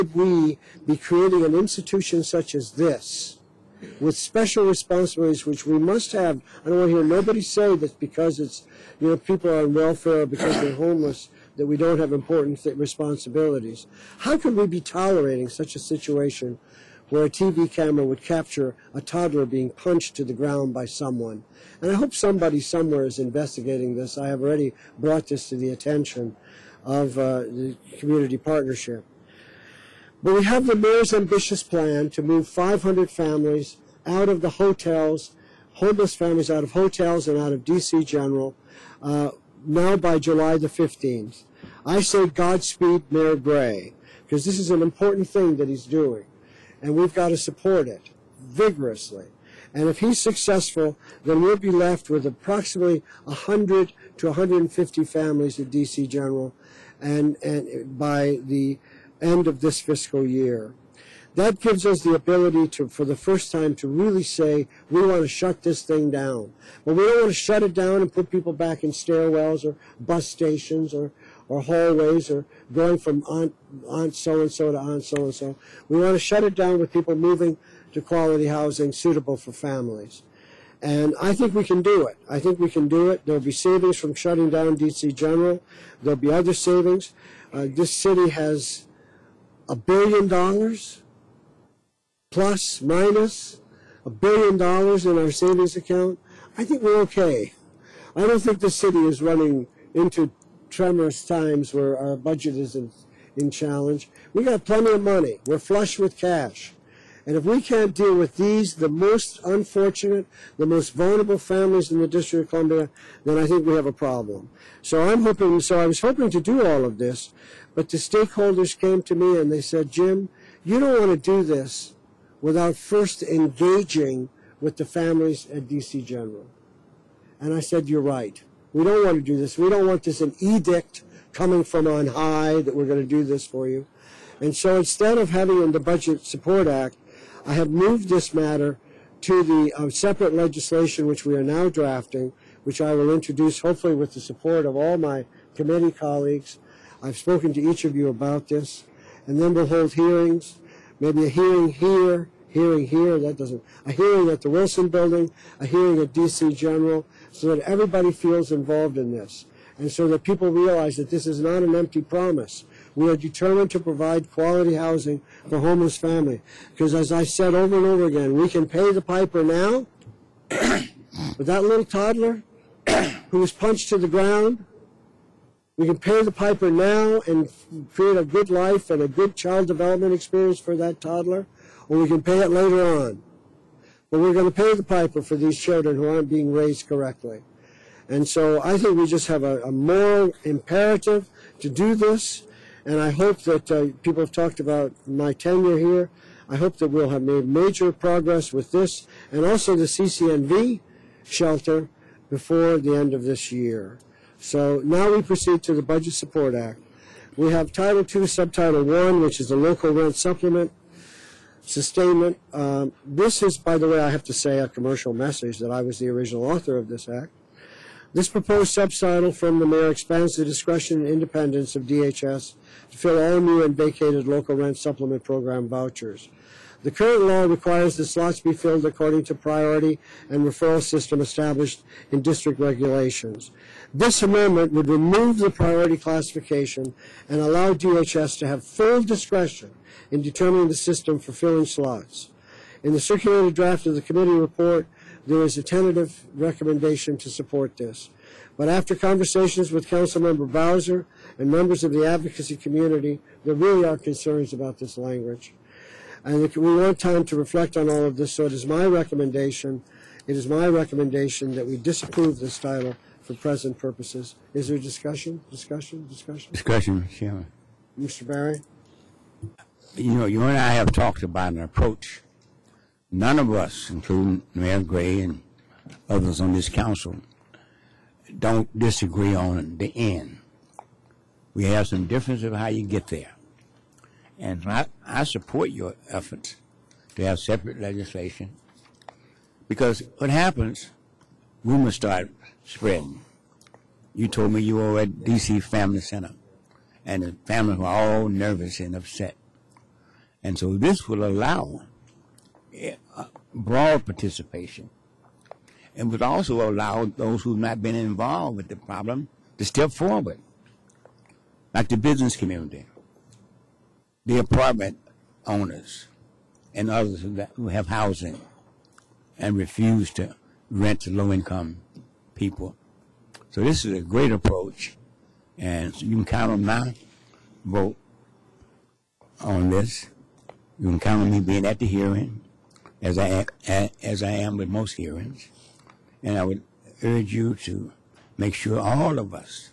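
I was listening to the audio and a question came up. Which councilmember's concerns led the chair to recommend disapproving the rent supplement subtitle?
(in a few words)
Bowser.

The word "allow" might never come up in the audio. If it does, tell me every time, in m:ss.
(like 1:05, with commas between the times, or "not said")
3:57, 5:01, 5:06.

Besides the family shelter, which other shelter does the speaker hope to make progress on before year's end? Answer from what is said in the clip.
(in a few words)
CCNV shelter.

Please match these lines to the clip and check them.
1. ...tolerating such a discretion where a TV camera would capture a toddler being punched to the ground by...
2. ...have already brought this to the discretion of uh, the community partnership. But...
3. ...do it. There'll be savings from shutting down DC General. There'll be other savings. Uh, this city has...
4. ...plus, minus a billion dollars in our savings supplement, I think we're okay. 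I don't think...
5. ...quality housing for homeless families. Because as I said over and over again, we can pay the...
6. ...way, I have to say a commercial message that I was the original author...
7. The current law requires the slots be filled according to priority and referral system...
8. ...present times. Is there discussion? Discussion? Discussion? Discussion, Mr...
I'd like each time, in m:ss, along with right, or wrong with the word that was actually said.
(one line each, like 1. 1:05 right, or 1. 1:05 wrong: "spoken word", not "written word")
1. 0:14 wrong: "situation", not "discretion"
2. 0:24 wrong: "attention", not "discretion"
3. 1:22 right
4. 1:32 wrong: "account", not "supplement"
5. 2:44 right
6. 3:33 right
7. 3:46 right
8. 4:23 wrong: "purposes", not "times".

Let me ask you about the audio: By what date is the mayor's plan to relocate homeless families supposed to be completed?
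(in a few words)
July 15.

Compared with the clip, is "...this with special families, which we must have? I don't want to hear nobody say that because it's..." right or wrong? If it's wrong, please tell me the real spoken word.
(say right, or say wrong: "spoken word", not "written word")
wrong: "responsibilities", not "families".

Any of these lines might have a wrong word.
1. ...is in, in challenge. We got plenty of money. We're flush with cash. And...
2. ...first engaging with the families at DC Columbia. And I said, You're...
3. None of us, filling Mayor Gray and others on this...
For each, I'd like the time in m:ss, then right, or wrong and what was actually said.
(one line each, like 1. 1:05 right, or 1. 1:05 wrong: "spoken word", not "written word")
1. 1:42 right
2. 2:02 wrong: "General", not "Columbia"
3. 4:33 wrong: "including", not "filling".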